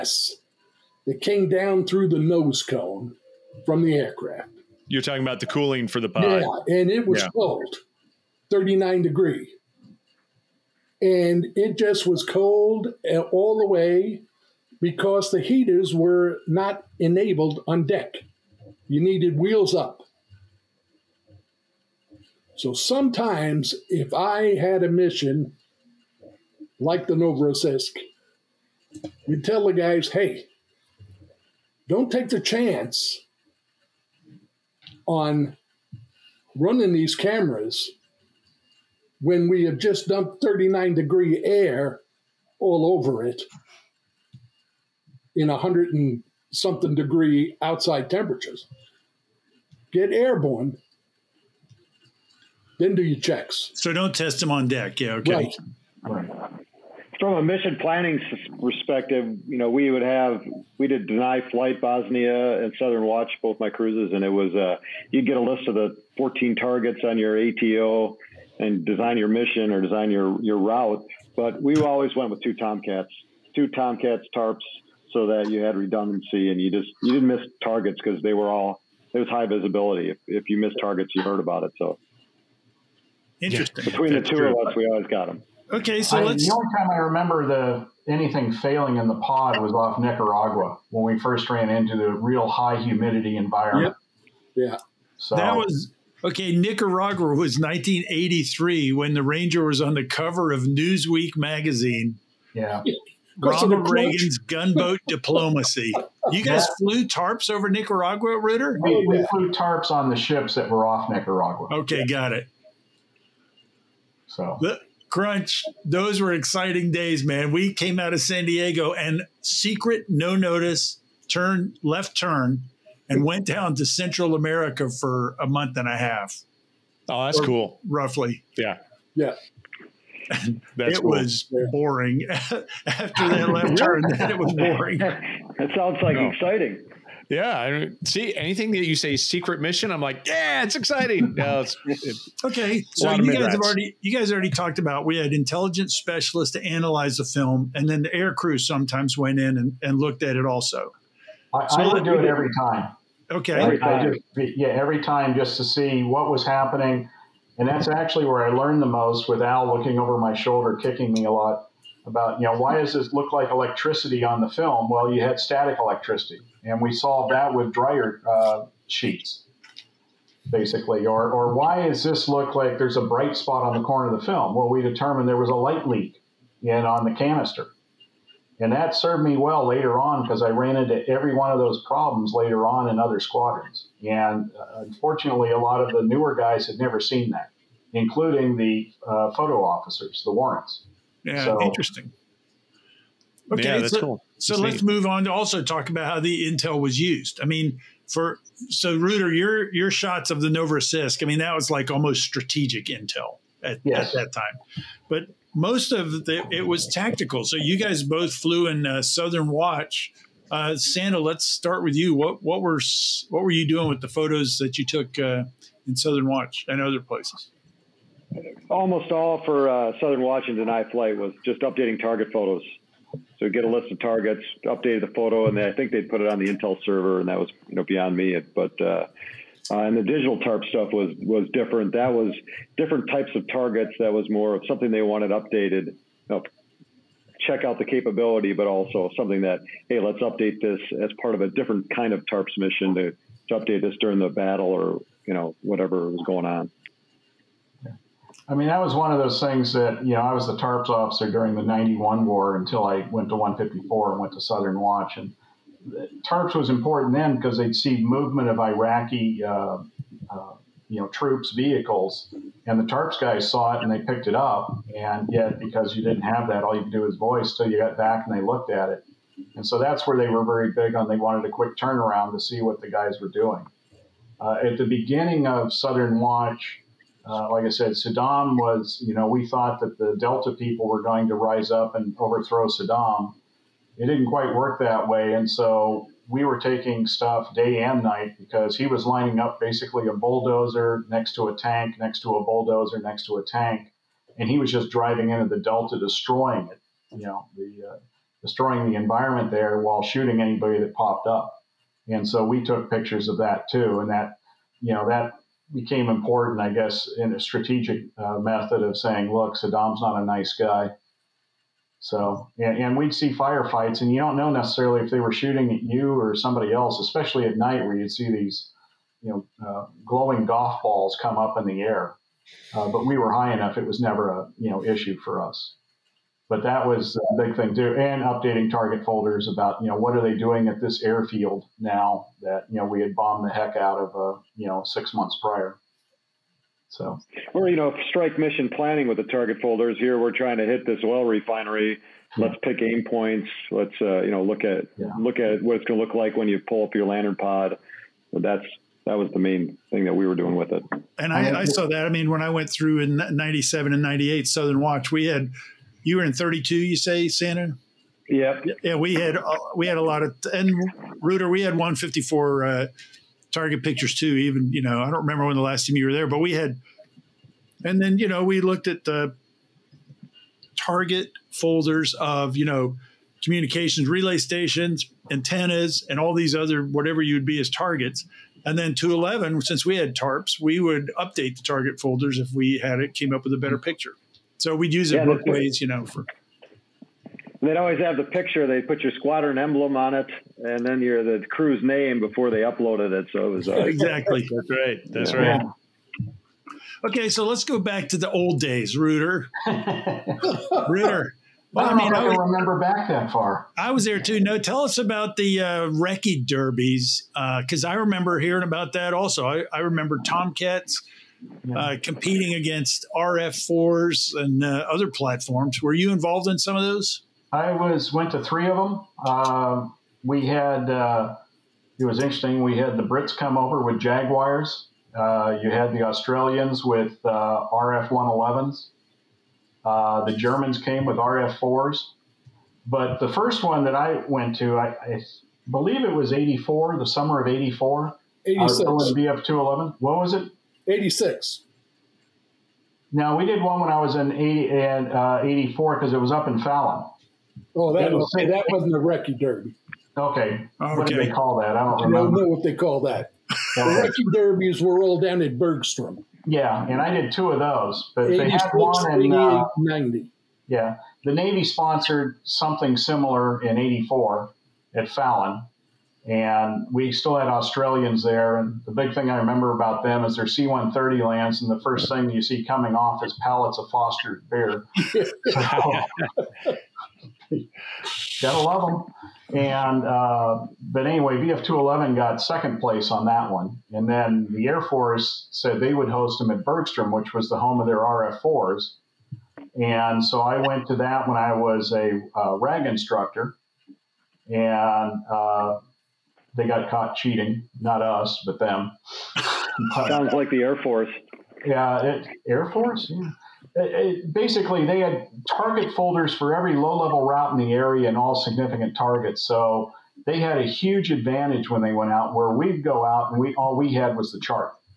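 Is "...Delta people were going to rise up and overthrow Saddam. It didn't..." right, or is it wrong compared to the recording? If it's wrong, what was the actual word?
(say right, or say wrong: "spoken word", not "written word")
right.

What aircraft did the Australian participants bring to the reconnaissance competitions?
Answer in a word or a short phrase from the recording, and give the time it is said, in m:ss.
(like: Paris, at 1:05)
RF111s, at 7:07.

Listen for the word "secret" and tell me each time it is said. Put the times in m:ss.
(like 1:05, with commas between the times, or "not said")
1:59, 2:19.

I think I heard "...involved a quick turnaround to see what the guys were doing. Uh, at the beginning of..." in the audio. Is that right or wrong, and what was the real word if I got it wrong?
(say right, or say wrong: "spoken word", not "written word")
wrong: "wanted", not "involved".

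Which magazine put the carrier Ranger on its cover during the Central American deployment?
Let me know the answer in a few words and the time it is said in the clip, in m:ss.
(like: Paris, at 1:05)
Newsweek, at 1:40.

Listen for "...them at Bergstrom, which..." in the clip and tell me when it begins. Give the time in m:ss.
8:06.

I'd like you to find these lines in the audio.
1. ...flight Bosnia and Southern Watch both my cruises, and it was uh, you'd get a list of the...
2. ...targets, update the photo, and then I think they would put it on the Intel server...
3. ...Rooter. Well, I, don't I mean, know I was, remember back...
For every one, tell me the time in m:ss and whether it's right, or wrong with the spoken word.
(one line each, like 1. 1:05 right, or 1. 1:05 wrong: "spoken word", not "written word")
1. 1:01 right
2. 3:43 right
3. 6:39 right.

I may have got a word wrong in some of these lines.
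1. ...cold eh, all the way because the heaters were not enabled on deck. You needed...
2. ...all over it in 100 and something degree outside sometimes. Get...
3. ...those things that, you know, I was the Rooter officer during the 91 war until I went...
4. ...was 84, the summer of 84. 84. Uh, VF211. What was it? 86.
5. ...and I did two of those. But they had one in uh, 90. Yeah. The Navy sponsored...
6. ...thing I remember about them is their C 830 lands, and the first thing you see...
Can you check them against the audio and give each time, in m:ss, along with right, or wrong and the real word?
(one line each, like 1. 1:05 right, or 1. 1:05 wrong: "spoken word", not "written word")
1. 0:12 right
2. 0:42 wrong: "temperatures", not "sometimes"
3. 4:09 wrong: "TARPS", not "Rooter"
4. 7:16 wrong: "86", not "84"
5. 7:36 right
6. 7:49 wrong: "130", not "830".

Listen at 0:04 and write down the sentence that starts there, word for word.
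You're talking about the cooling for the pod.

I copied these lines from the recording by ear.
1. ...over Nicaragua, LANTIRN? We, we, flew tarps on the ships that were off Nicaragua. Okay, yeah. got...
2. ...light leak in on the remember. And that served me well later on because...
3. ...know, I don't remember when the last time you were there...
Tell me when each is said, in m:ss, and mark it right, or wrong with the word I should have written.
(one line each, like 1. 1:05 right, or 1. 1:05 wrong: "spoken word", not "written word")
1. 1:47 wrong: "Rooter", not "LANTIRN"
2. 2:55 wrong: "canister", not "remember"
3. 6:04 right.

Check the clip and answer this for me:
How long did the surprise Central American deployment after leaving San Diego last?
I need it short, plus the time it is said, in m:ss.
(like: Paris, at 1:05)
a month and a half, at 2:05.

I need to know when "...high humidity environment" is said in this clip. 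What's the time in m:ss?
1:32.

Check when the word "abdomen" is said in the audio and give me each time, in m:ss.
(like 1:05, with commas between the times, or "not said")
not said.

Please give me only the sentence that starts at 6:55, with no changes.
Were you involved in some of those?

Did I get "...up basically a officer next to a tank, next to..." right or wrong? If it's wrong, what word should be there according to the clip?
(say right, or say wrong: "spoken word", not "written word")
wrong: "bulldozer", not "officer".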